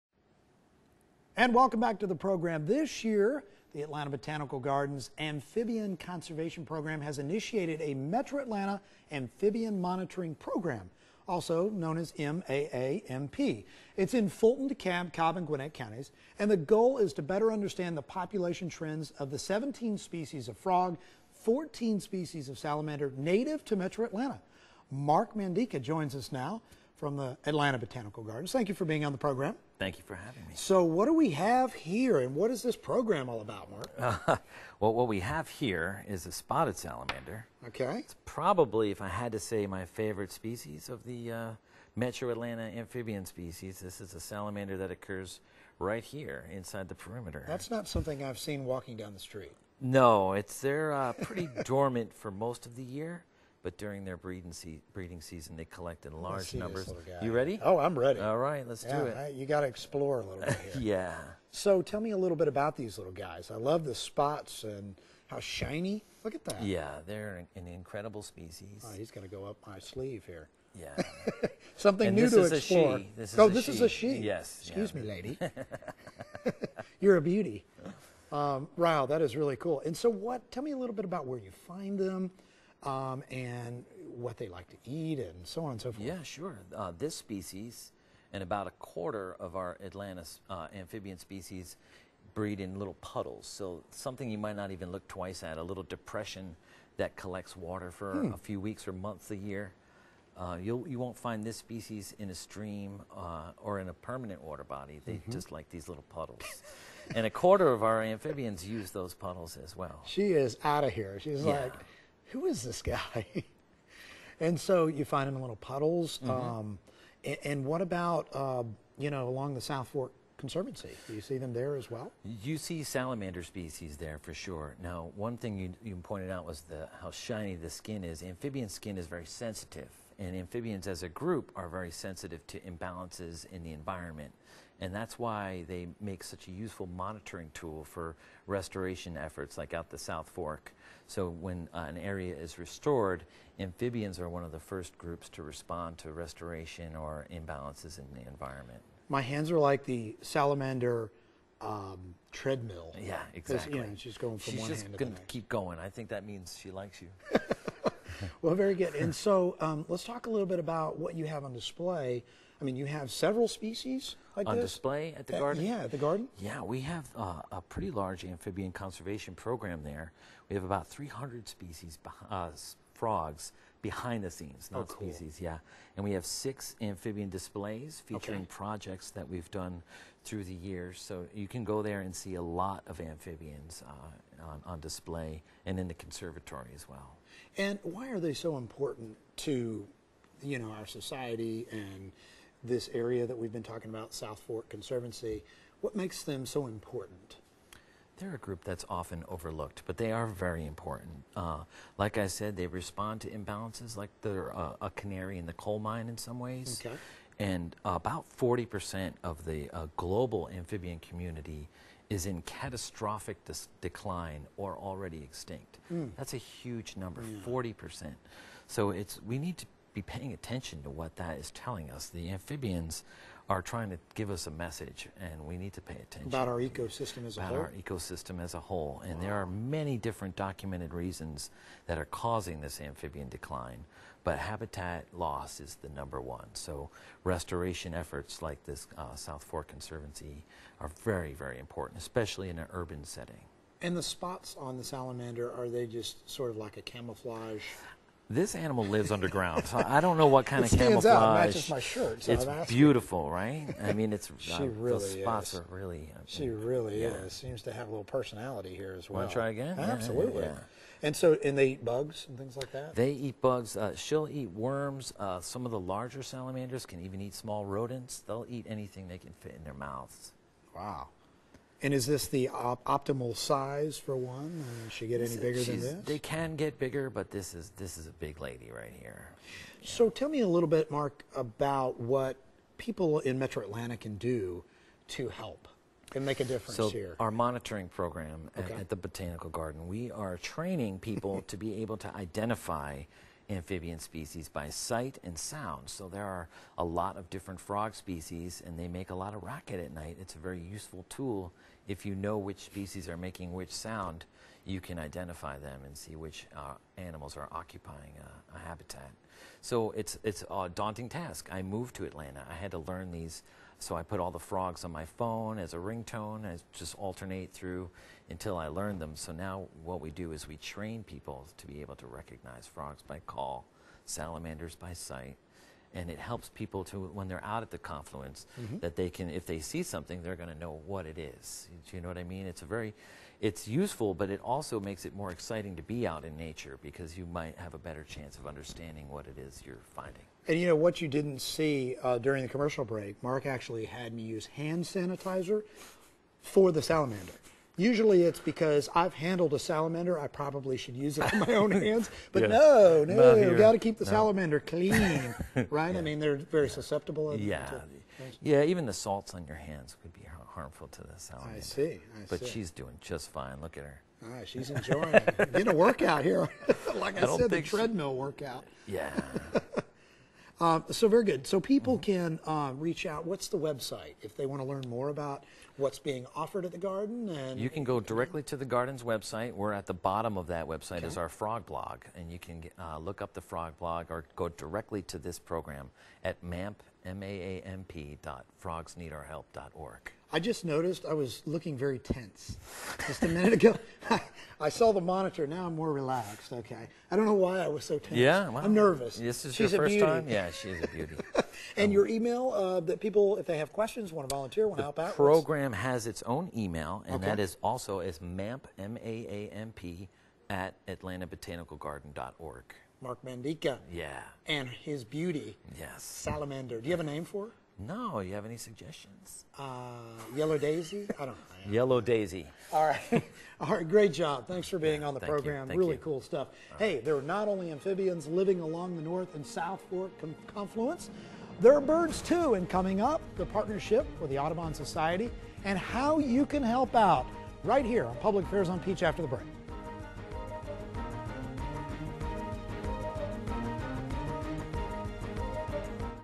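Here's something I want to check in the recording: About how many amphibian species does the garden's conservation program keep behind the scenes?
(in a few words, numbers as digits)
300.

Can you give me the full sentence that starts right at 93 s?
So something you might not even look twice at, a little depression that collects water for hmm.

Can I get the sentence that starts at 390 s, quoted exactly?
I just noticed I was looking very tense just a minute ago.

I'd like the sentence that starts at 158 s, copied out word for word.
And so um, let's talk a little bit about what you have on display.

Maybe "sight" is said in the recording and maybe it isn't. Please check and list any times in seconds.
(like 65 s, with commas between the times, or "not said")
294 s, 324 s.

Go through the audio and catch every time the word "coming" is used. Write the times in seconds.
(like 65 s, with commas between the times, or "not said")
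432 s.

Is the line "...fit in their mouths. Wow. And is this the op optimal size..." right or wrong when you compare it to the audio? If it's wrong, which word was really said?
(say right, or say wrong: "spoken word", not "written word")
right.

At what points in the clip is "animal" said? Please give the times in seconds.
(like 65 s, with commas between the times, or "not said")
248 s, 306 s.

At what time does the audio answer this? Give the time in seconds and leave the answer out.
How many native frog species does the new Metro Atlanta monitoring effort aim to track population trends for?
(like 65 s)
19 s.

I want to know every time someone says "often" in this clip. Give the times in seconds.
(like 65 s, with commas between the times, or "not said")
198 s.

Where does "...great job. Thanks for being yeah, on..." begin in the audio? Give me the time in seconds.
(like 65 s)
423 s.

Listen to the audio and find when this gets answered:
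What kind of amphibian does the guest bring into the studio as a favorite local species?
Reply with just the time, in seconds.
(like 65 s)
36 s.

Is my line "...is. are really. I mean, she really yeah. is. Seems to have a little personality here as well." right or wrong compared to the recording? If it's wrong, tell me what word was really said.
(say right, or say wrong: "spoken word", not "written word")
right.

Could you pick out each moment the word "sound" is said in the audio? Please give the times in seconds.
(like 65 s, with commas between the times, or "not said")
295 s, 303 s.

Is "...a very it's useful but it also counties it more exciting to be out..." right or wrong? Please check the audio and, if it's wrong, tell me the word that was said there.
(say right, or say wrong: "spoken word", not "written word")
wrong: "makes", not "counties".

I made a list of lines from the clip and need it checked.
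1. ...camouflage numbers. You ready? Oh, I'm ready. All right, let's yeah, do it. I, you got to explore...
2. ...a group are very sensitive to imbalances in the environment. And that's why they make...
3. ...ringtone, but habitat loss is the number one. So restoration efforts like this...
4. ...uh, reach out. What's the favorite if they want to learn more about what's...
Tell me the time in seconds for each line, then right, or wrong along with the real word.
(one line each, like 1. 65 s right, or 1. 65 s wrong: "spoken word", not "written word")
1. 56 s wrong: "large", not "camouflage"
2. 131 s right
3. 233 s wrong: "decline", not "ringtone"
4. 372 s wrong: "website", not "favorite".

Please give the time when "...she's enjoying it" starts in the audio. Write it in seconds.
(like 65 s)
364 s.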